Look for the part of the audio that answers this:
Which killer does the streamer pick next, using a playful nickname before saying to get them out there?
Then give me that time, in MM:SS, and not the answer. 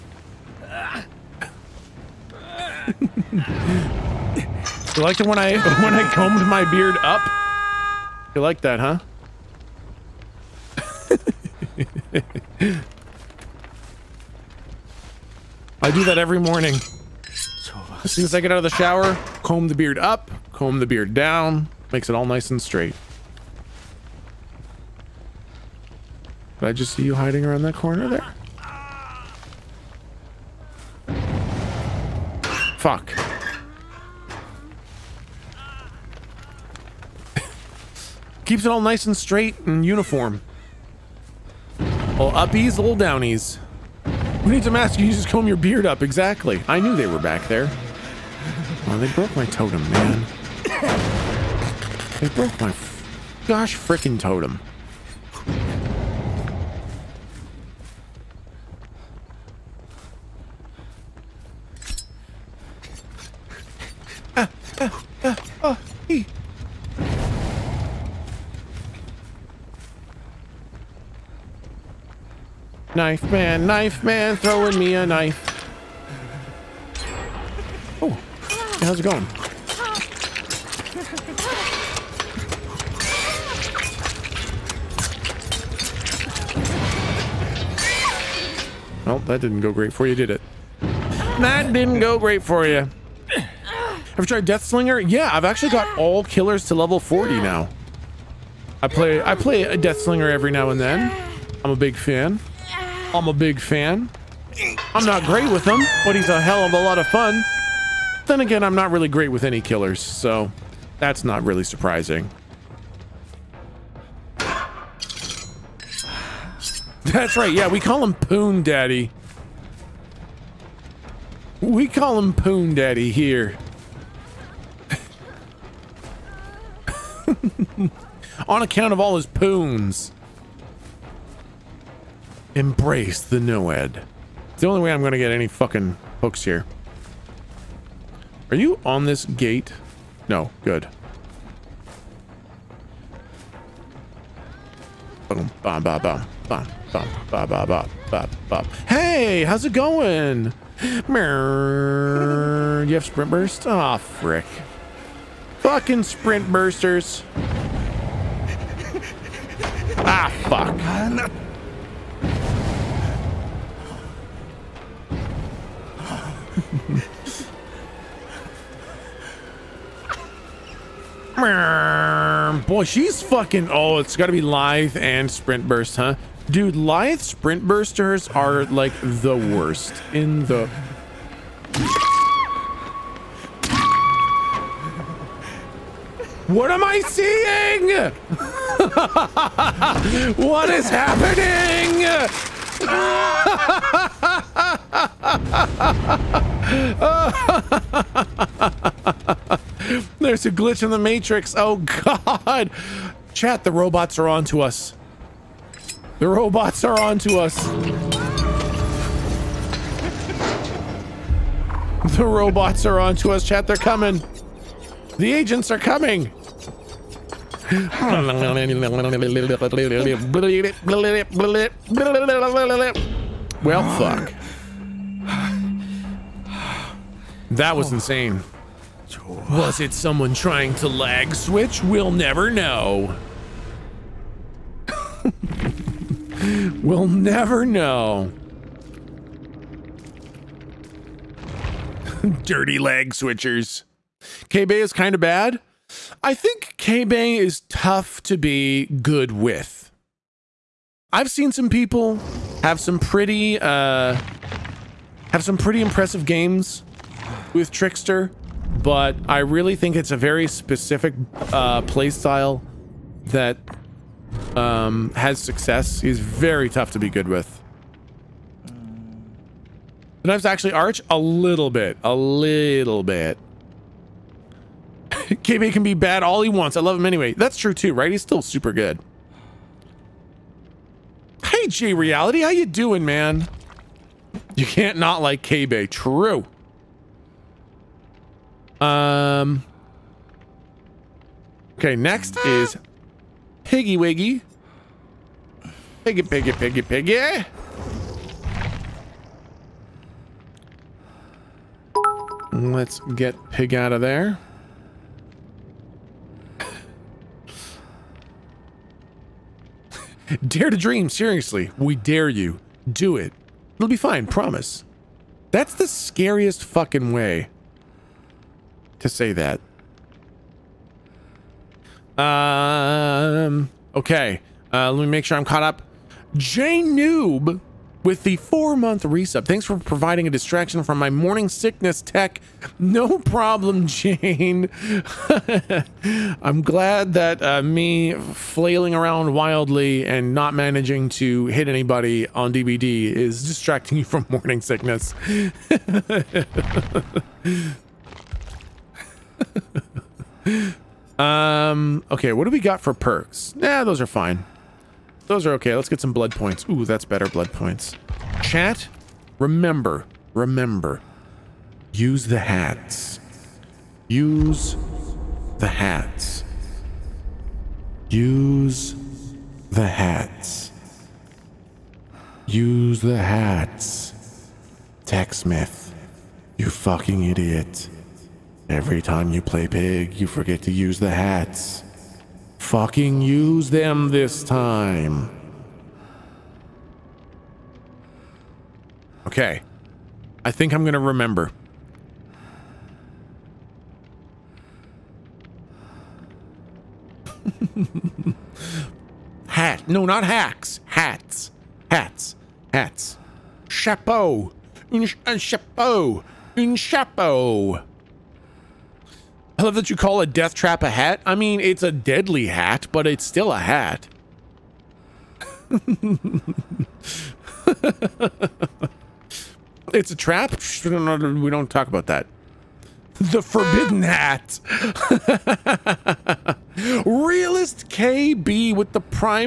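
04:53.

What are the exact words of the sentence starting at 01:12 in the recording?
Knife man, knife man, throwing me a knife.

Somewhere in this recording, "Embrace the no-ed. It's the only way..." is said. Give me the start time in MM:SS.
02:12.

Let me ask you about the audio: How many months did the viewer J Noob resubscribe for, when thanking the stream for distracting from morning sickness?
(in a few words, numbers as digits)
4.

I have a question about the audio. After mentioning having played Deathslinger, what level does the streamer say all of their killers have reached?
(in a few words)
40.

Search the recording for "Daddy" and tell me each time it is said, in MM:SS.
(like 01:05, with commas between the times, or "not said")
01:58, 02:02.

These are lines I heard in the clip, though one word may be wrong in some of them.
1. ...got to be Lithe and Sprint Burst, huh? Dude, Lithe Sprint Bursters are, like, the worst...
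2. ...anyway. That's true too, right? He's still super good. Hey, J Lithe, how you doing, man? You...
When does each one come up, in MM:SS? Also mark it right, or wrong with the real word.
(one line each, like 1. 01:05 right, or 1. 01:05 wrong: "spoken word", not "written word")
1. 02:54 right
2. 04:37 wrong: "Reality", not "Lithe".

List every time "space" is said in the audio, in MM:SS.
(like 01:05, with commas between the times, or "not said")
not said.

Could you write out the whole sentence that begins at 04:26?
He's very tough to be good with.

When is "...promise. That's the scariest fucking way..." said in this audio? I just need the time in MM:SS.
05:14.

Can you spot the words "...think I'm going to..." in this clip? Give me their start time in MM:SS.
06:30.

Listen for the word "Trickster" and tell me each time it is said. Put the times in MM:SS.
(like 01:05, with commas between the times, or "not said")
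04:17.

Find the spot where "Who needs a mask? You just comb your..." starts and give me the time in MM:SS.
00:44.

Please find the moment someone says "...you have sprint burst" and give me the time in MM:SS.
02:32.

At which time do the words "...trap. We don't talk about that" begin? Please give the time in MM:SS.
07:00.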